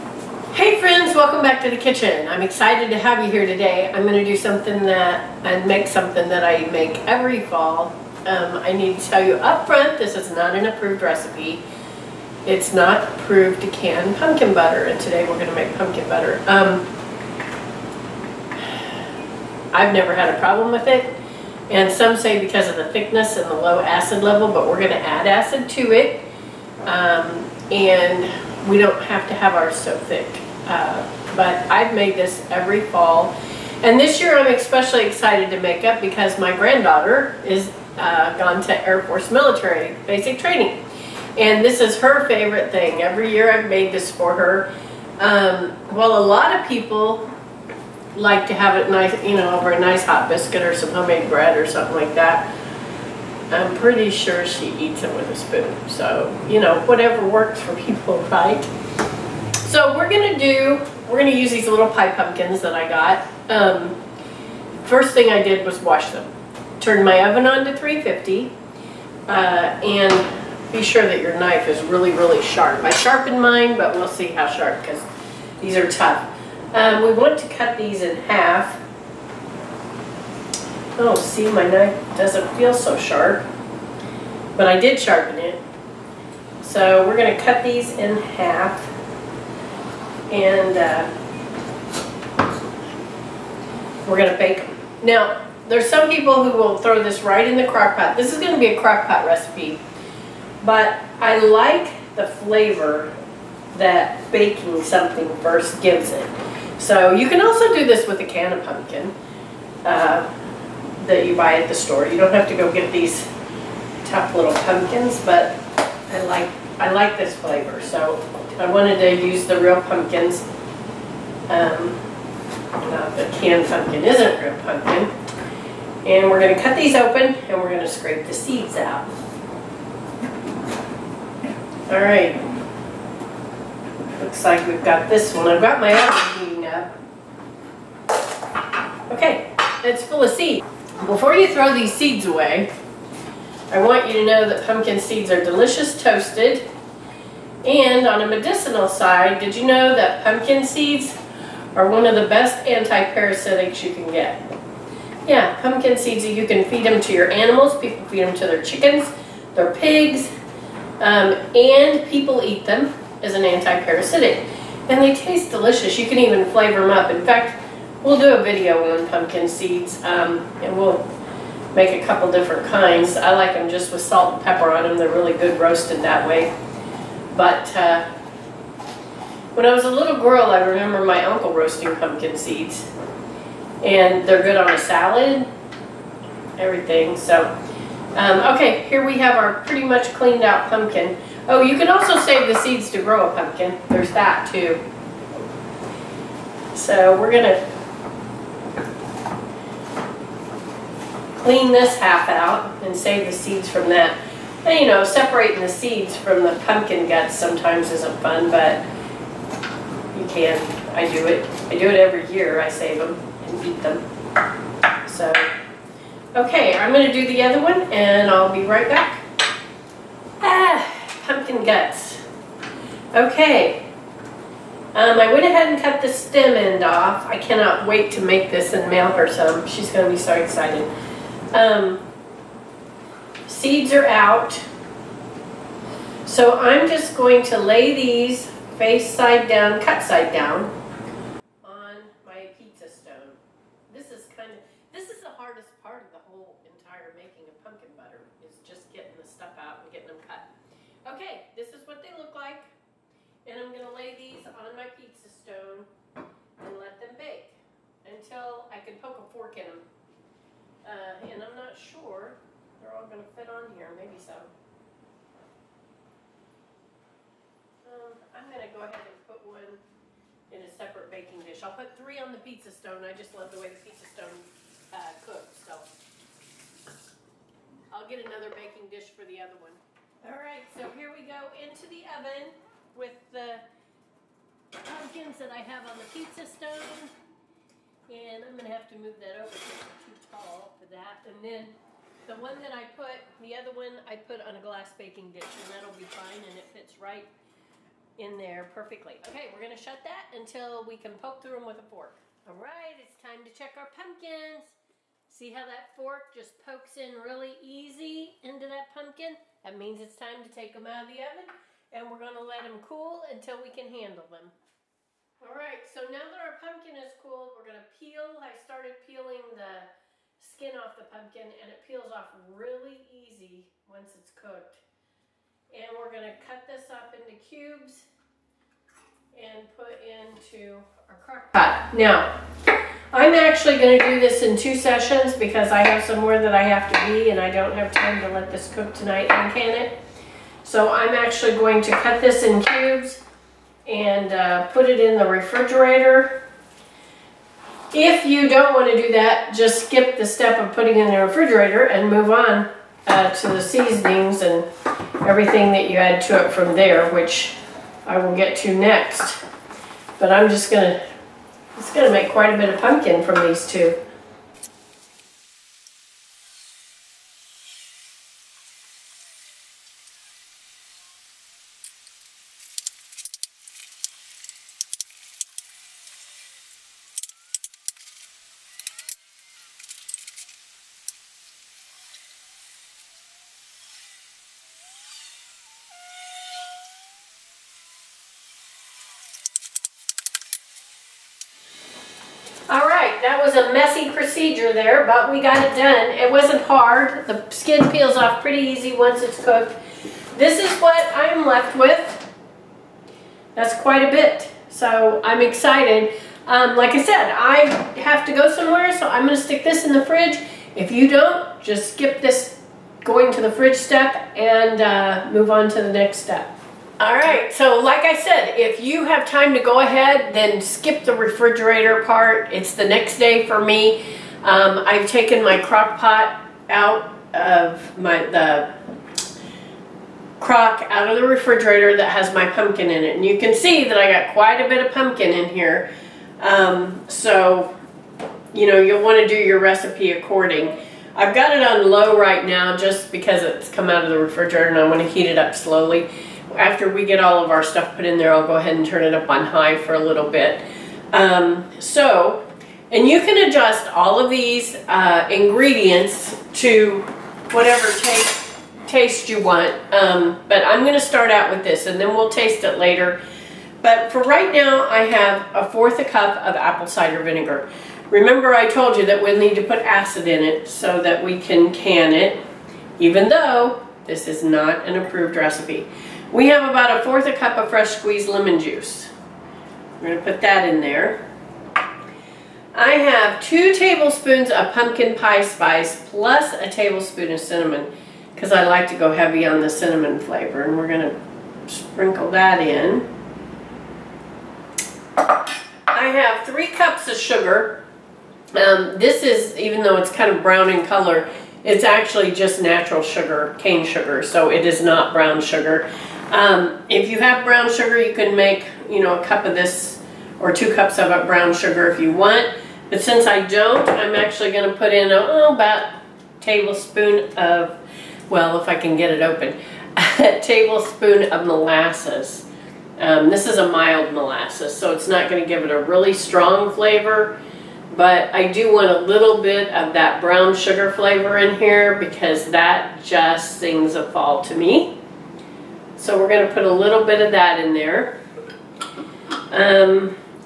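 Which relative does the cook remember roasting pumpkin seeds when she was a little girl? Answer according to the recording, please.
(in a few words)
uncle.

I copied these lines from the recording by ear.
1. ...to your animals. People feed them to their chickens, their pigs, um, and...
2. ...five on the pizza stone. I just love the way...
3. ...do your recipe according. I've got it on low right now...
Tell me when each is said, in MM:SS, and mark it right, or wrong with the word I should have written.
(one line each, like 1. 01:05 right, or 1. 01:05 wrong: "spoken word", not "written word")
1. 02:37 right
2. 04:31 wrong: "three", not "five"
3. 07:19 right.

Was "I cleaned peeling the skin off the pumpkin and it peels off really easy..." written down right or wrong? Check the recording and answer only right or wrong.
wrong.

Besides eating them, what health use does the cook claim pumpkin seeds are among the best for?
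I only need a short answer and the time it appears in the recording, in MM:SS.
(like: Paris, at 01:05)
anti-parasitic, at 02:32.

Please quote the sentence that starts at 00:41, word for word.
And this is her favorite thing.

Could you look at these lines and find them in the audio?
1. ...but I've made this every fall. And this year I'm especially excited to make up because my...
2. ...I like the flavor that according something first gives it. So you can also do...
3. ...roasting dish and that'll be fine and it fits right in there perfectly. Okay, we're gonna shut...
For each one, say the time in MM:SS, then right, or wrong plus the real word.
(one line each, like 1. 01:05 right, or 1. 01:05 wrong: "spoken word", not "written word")
1. 00:31 right
2. 01:41 wrong: "baking", not "according"
3. 04:54 wrong: "baking", not "roasting".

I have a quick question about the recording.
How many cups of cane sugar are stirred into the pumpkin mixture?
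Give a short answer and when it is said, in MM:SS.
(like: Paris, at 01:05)
3, at 08:16.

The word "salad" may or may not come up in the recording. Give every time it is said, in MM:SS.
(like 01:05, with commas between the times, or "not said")
03:04.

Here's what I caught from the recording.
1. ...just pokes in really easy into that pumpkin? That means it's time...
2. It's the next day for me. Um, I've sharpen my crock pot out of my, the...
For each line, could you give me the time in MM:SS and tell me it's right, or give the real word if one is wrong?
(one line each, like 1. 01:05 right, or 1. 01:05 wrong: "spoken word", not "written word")
1. 05:06 right
2. 07:02 wrong: "taken", not "sharpen".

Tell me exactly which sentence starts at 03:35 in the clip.
So, okay, I'm going to do the other one and I'll be right back.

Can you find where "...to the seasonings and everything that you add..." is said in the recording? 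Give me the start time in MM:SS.
05:53.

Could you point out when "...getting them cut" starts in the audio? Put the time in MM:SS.
04:09.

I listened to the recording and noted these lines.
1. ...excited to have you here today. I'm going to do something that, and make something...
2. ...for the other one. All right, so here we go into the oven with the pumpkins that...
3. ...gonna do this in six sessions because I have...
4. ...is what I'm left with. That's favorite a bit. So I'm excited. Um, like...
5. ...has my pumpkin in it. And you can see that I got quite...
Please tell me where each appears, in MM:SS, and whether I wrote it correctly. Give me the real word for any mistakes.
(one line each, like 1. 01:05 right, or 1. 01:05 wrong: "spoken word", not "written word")
1. 00:02 right
2. 04:39 right
3. 05:33 wrong: "two", not "six"
4. 06:40 wrong: "quite", not "favorite"
5. 07:12 right.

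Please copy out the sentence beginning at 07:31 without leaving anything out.
Um, so, and you can adjust all of these uh, ingredients to whatever taste, taste you want.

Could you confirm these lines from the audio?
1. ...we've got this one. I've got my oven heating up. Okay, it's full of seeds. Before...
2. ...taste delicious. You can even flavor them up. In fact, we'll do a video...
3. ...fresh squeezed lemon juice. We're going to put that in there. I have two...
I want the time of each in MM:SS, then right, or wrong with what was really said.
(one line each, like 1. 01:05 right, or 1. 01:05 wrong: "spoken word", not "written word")
1. 02:14 right
2. 02:45 right
3. 07:57 right.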